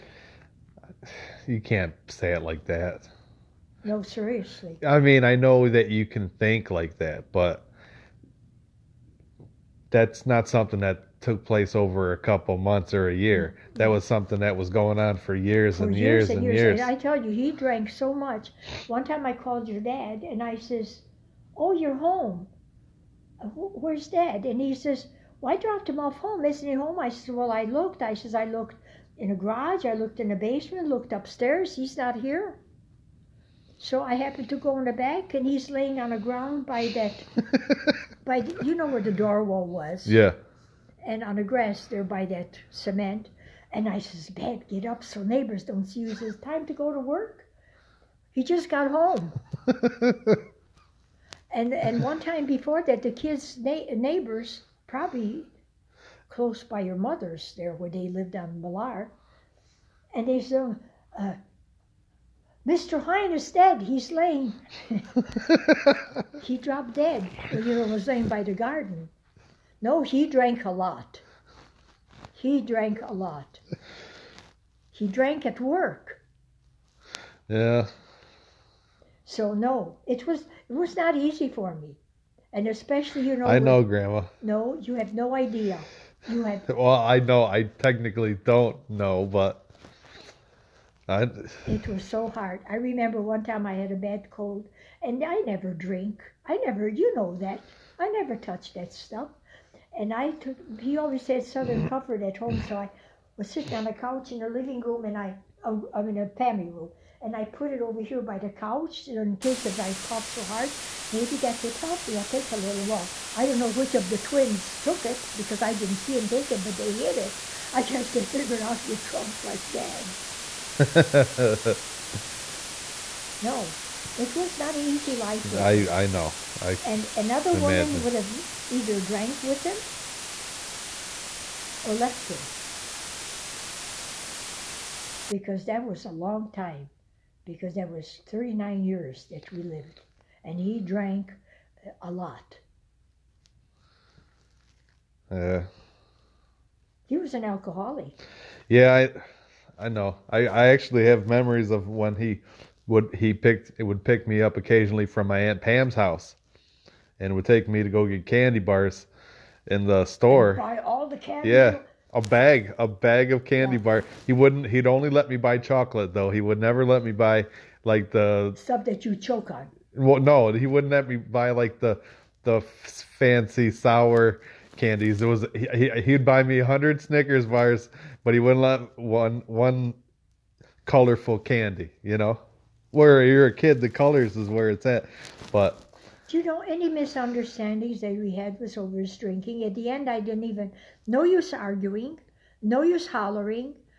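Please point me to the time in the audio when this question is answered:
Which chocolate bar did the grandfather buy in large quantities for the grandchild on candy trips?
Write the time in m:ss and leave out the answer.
2:57.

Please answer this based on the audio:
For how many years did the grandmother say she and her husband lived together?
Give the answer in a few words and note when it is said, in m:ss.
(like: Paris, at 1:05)
39, at 2:18.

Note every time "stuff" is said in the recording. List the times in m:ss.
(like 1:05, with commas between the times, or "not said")
1:38, 2:48.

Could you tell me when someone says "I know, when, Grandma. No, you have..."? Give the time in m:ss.
1:23.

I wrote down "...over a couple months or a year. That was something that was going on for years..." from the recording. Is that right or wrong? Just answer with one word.
right.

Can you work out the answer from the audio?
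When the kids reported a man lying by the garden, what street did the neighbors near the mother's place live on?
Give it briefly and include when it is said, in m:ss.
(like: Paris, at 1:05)
Millar, at 0:58.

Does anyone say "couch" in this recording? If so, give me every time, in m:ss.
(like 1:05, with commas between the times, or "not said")
1:43, 1:48.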